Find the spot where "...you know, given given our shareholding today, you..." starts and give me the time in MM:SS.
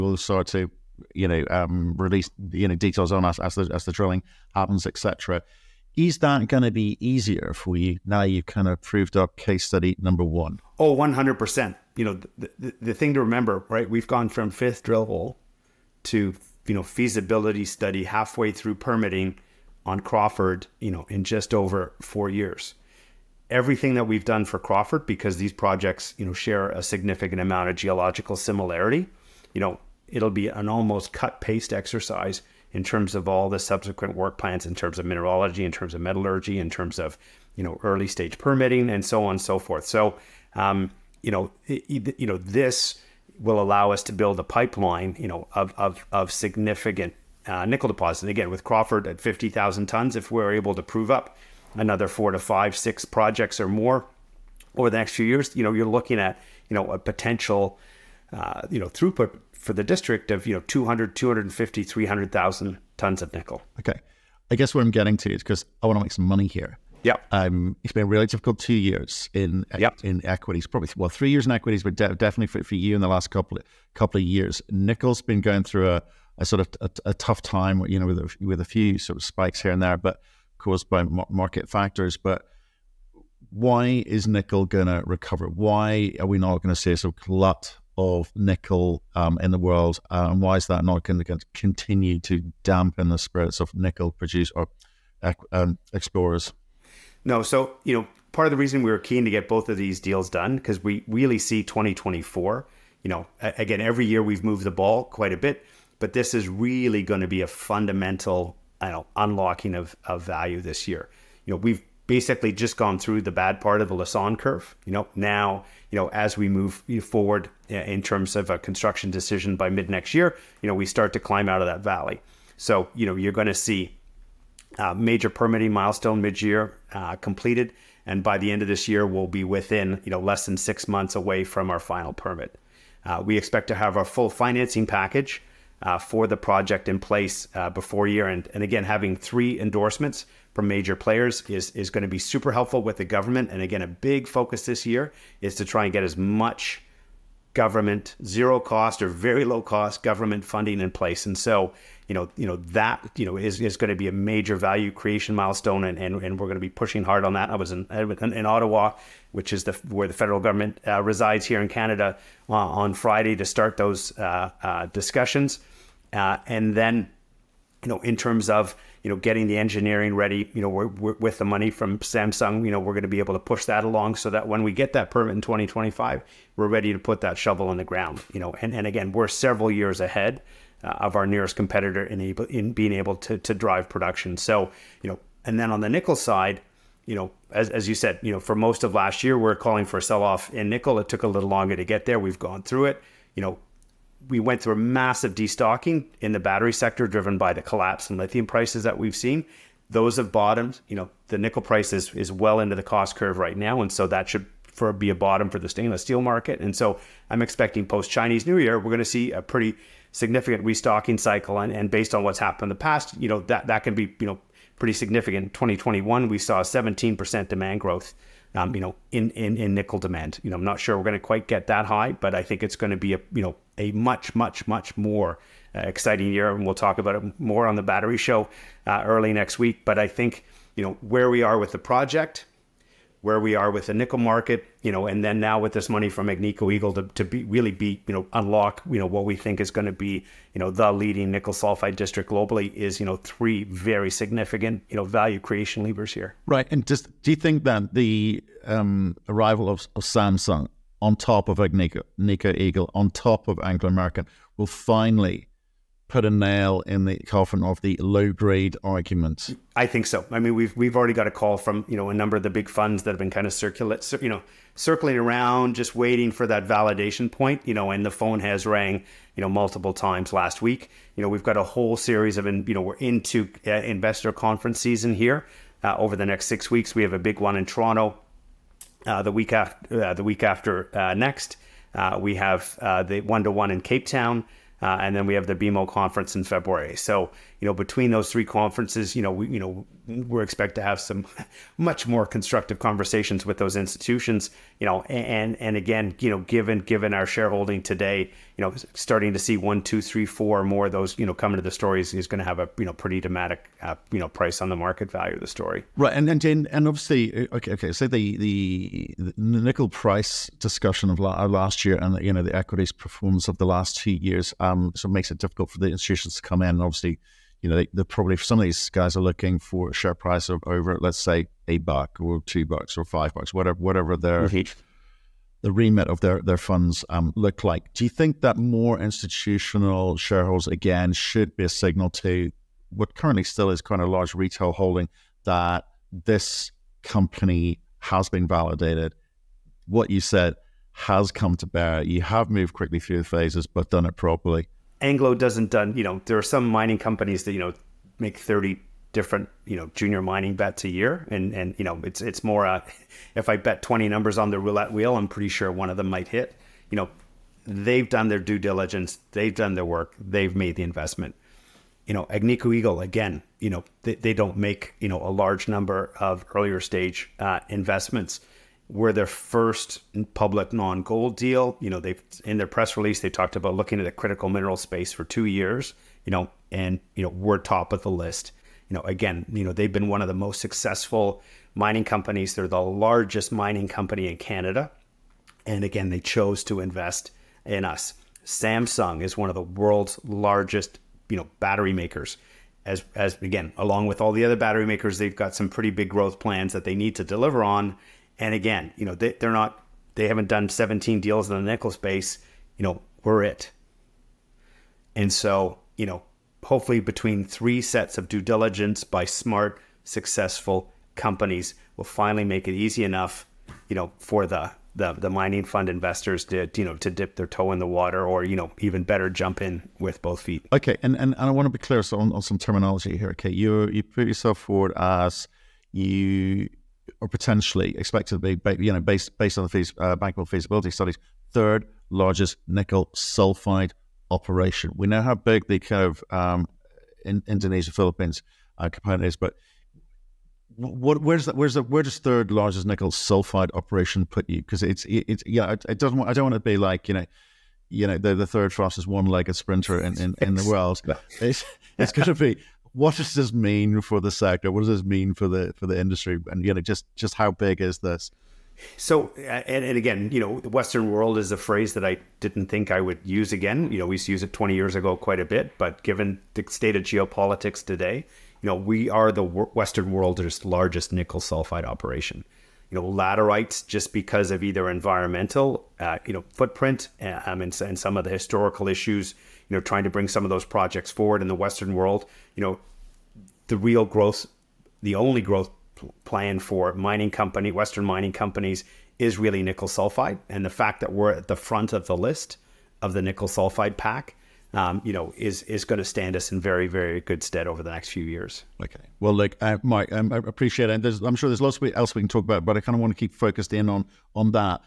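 04:56.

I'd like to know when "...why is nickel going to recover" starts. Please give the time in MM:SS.
01:23.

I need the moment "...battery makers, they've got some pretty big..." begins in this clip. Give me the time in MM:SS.
06:34.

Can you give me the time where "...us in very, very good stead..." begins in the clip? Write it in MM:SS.
08:16.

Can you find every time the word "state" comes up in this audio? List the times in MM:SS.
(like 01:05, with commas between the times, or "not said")
07:46.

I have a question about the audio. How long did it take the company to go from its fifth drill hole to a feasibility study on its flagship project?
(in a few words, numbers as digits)
just over 4 years.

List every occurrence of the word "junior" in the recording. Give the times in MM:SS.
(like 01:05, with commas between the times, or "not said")
05:49.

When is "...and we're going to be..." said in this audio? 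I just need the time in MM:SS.
02:36.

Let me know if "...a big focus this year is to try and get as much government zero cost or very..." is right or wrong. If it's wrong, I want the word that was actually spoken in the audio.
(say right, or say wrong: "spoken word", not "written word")
right.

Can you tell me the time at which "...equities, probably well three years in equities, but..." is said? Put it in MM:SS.
01:10.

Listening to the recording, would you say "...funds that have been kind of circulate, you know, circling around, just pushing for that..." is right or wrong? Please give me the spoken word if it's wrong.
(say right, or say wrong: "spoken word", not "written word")
wrong: "waiting", not "pushing".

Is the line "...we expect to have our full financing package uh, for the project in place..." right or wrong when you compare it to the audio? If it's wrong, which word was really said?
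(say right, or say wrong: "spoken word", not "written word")
right.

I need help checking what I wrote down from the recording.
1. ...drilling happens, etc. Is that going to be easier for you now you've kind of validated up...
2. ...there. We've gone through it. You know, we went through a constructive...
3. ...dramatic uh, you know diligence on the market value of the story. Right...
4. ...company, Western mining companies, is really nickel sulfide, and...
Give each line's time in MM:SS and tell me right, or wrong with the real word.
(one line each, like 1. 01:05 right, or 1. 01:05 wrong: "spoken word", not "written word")
1. 00:03 wrong: "proved", not "validated"
2. 03:12 wrong: "massive", not "constructive"
3. 05:03 wrong: "price", not "diligence"
4. 08:07 right.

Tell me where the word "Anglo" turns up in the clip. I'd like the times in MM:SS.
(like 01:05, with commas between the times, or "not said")
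04:13, 05:45.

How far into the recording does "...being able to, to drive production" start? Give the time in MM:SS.
03:02.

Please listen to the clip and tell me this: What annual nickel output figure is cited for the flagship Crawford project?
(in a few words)
50,000 tons.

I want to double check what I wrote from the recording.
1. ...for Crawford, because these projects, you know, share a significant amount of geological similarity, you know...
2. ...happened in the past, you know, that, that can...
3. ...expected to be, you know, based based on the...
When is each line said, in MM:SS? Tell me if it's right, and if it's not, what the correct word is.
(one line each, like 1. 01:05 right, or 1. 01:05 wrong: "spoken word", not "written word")
1. 00:24 right
2. 03:32 right
3. 07:07 right.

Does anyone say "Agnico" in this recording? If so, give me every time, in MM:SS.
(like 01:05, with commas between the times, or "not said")
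03:56, 04:11, 06:02.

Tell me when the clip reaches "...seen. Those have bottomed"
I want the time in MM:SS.
03:19.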